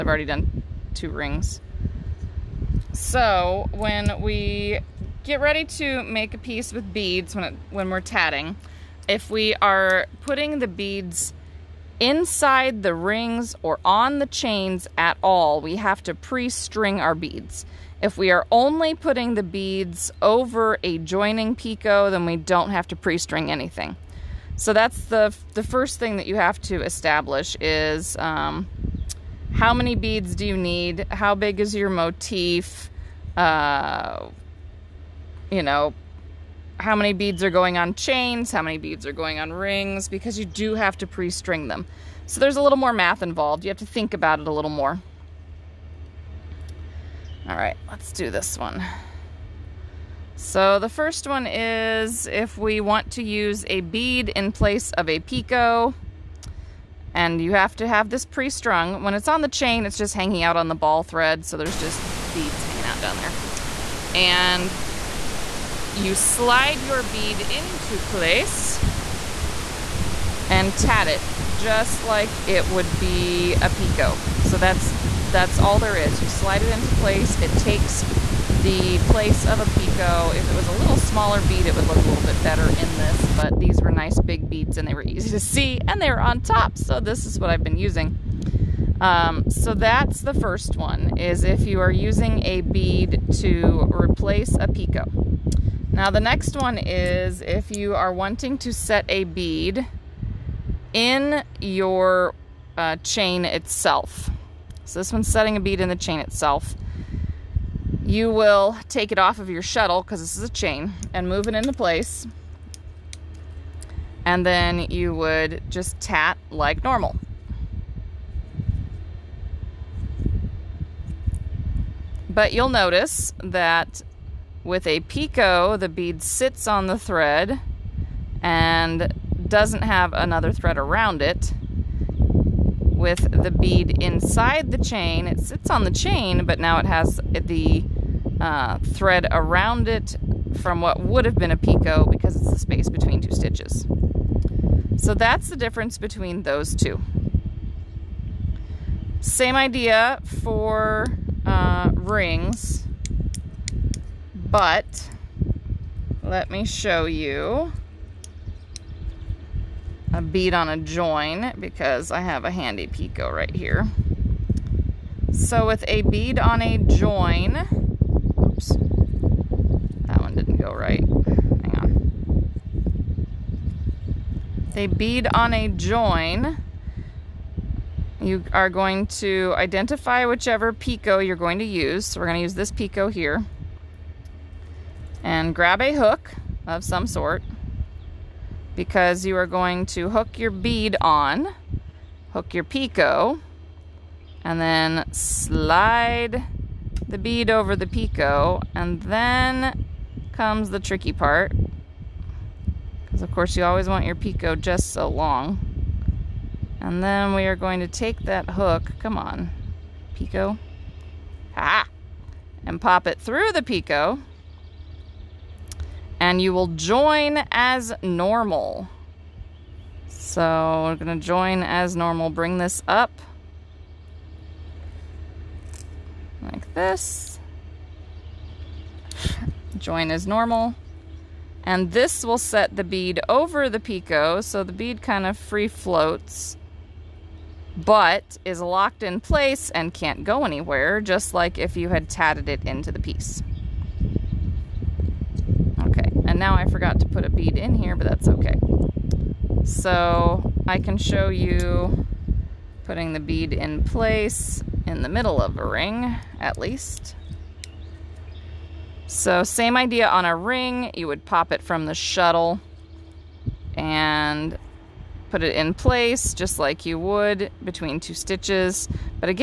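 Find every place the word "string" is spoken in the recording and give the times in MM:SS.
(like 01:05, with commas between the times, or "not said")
00:16, 00:22, 00:41.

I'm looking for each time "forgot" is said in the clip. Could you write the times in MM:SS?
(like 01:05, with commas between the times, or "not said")
04:06.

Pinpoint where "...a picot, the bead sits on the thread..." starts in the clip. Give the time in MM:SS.
02:04.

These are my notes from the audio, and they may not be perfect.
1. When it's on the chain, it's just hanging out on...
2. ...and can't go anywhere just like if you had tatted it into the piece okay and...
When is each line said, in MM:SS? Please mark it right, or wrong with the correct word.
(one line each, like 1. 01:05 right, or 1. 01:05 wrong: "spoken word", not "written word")
1. 00:59 right
2. 03:59 right.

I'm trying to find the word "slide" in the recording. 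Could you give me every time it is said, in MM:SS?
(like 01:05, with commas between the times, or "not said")
01:06, 01:16, 03:15.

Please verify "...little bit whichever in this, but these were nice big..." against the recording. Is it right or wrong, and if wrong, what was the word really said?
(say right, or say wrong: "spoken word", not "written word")
wrong: "better", not "whichever".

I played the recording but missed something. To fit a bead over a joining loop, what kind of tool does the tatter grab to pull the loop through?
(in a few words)
A hook.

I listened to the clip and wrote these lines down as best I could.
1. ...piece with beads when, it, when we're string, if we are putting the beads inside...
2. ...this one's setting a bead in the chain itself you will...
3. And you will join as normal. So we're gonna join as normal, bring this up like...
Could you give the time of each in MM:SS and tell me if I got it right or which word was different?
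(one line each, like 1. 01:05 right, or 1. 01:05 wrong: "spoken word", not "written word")
1. 00:06 wrong: "tatting", not "string"
2. 01:44 right
3. 03:36 right.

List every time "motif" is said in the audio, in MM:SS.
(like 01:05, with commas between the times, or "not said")
00:31.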